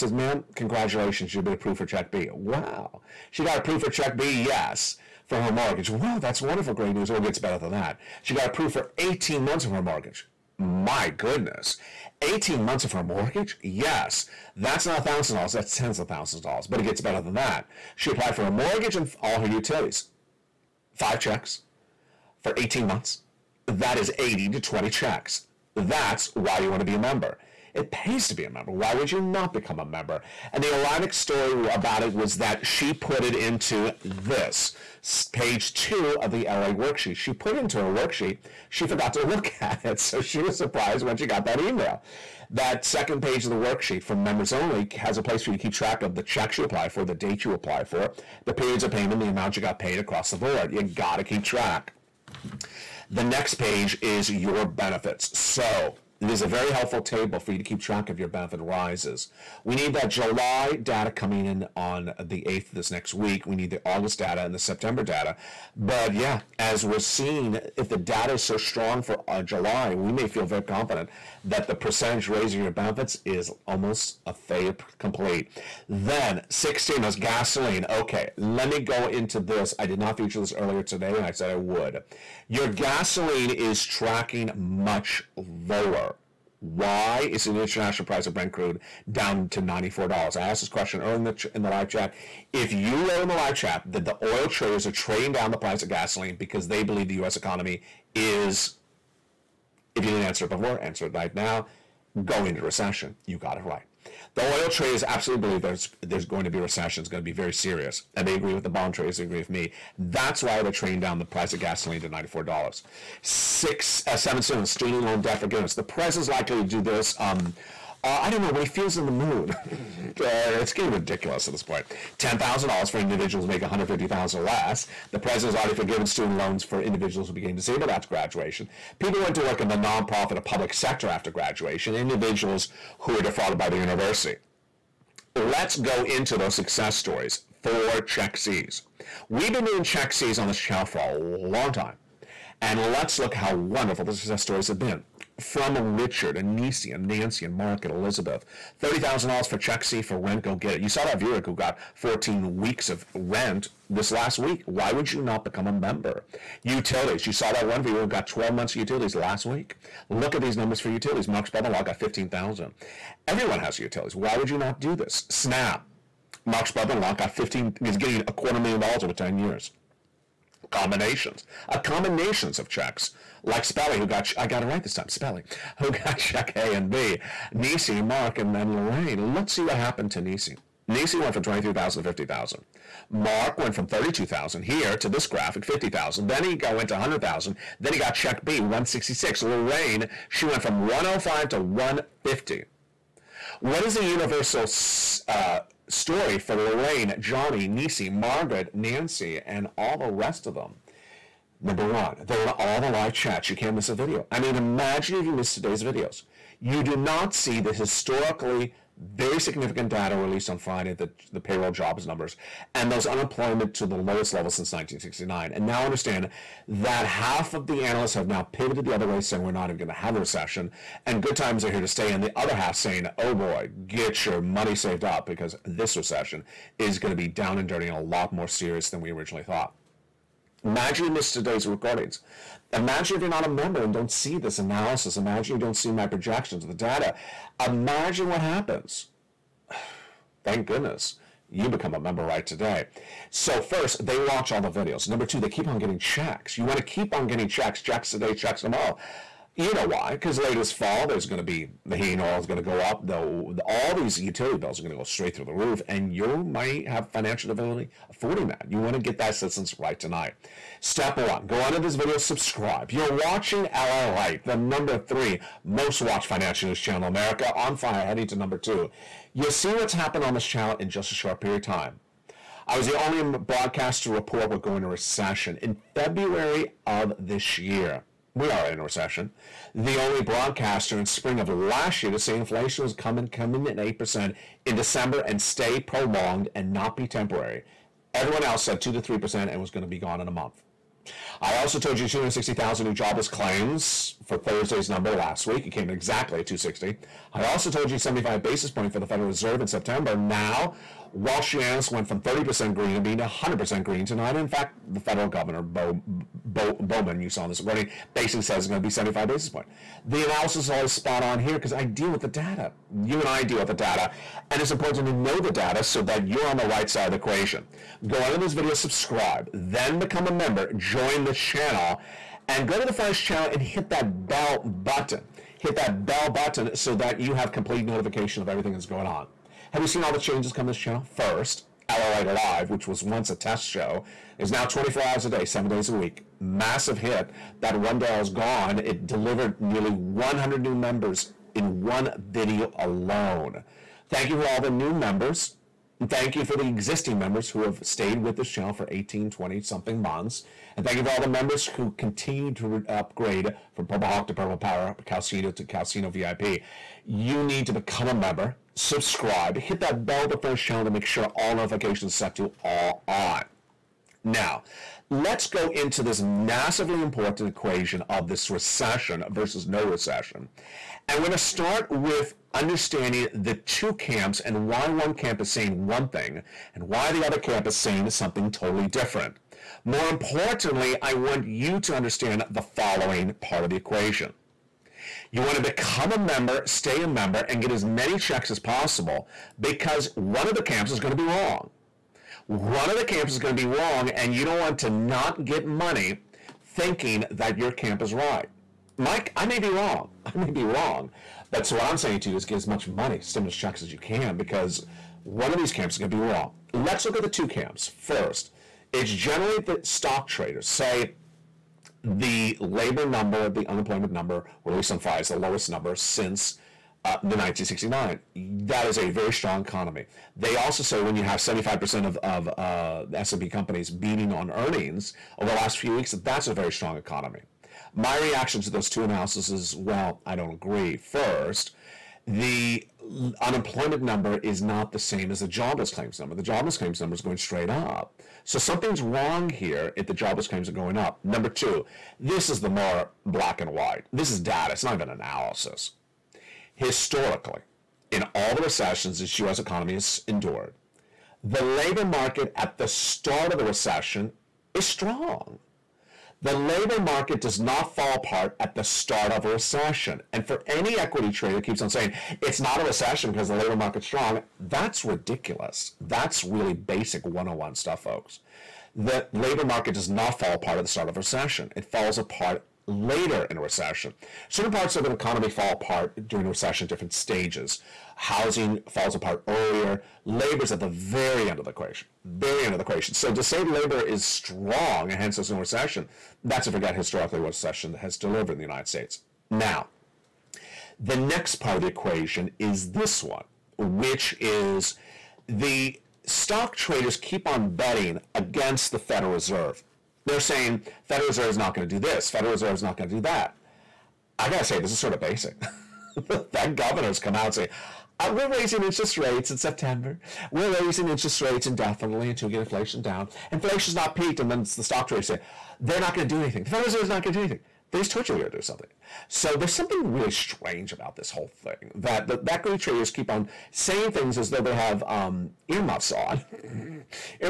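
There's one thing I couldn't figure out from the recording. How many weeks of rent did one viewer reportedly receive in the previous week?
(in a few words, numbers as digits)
14.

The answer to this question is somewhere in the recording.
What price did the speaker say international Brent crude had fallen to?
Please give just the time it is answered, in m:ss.
1:29.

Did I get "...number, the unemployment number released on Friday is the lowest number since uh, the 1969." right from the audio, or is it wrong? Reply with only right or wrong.
right.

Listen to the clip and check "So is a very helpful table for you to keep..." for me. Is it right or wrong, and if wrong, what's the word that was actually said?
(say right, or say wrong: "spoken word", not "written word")
right.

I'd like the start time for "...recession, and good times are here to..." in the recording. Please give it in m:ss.
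3:40.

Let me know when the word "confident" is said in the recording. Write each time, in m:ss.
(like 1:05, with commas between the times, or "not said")
1:10.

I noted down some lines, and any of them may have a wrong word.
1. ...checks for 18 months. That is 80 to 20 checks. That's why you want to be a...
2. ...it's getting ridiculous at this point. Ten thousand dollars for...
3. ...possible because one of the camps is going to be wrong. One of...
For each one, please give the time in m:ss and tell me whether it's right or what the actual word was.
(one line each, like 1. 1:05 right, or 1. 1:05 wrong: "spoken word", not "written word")
1. 0:21 right
2. 2:00 right
3. 6:28 right.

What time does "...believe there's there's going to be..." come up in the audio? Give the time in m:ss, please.
1:45.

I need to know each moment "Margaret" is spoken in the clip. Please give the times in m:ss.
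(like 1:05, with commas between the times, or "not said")
3:18.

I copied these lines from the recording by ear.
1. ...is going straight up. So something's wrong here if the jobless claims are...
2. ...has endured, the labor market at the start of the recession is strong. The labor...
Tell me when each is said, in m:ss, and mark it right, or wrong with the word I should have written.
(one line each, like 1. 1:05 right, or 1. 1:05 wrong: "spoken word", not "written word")
1. 7:17 right
2. 7:29 right.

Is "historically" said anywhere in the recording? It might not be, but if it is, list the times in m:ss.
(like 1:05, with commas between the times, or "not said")
3:27, 7:26, 8:06.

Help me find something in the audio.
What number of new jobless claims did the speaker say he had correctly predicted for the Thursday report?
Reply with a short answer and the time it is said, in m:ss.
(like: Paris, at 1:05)
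260,000, at 4:52.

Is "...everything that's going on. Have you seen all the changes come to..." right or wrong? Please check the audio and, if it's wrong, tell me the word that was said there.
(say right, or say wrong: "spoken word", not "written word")
right.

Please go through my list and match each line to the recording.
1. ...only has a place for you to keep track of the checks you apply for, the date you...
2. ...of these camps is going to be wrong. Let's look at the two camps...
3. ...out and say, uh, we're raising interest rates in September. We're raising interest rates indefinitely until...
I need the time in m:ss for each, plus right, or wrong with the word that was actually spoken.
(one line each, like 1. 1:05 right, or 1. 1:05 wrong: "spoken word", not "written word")
1. 0:44 right
2. 6:45 right
3. 8:27 right.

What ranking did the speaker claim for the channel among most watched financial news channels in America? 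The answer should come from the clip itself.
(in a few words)
number three.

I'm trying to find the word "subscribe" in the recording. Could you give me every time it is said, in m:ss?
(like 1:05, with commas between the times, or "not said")
4:22, 5:18, 5:58.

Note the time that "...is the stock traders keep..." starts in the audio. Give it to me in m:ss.
8:14.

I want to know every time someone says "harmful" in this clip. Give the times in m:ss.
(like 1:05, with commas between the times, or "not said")
not said.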